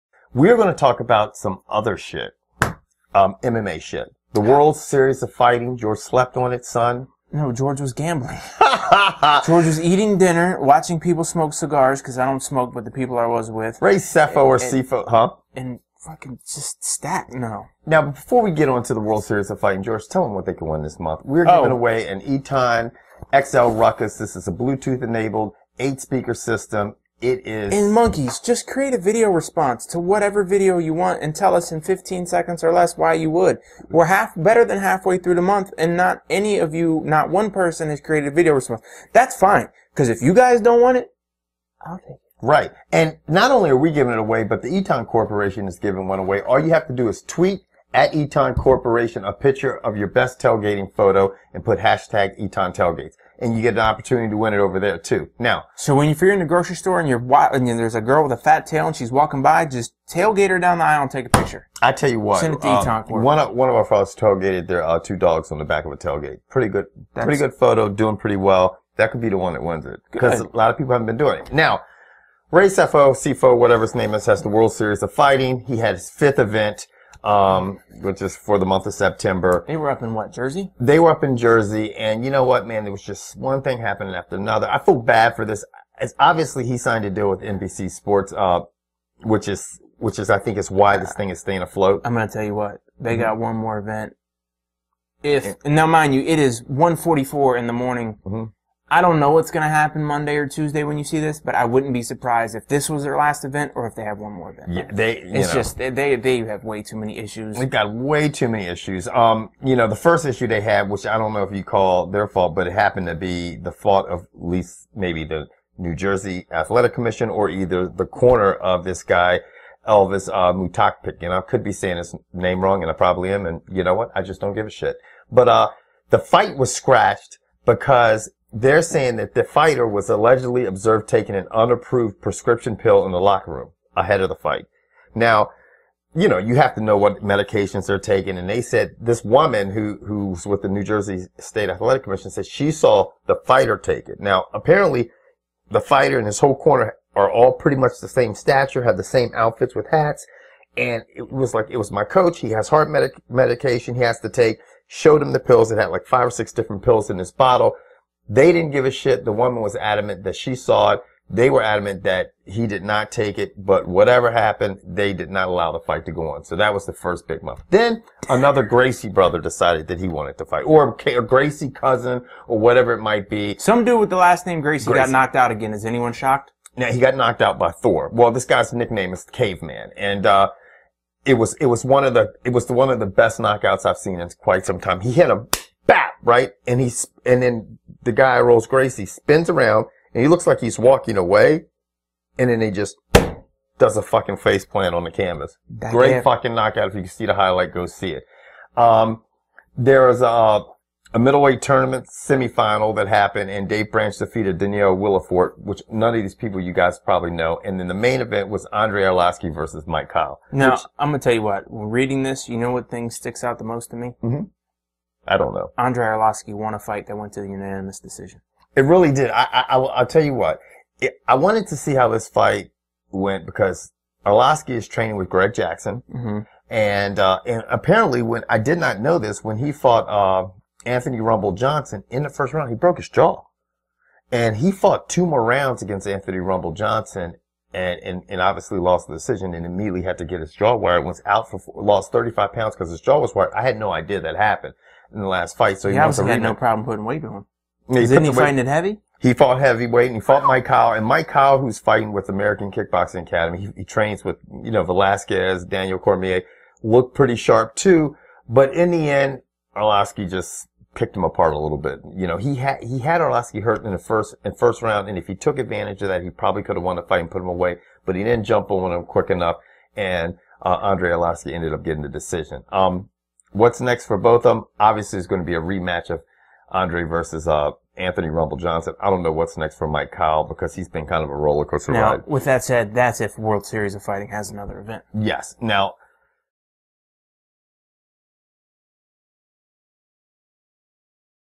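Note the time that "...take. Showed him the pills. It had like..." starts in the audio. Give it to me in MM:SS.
02:34.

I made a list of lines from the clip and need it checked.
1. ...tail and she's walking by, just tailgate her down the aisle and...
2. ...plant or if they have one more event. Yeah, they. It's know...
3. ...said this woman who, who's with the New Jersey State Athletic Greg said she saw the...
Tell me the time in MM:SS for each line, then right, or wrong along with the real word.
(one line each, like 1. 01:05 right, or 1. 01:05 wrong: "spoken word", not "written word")
1. 00:58 right
2. 01:43 wrong: "event", not "plant"
3. 02:18 wrong: "Commission", not "Greg".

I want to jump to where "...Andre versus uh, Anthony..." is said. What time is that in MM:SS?
04:36.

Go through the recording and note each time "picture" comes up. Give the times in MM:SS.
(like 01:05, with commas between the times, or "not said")
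00:49, 01:01.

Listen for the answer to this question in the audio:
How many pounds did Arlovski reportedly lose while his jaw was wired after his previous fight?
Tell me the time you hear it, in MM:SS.
04:02.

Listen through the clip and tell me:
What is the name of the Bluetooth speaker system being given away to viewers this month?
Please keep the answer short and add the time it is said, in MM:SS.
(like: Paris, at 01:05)
Eton XL Rukus, at 00:22.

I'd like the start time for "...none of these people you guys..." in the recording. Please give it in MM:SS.
03:25.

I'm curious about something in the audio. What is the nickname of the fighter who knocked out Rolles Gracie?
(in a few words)
Caveman.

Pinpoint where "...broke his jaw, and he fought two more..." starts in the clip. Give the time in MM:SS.
03:52.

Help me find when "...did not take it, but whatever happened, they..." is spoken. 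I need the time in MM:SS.
02:42.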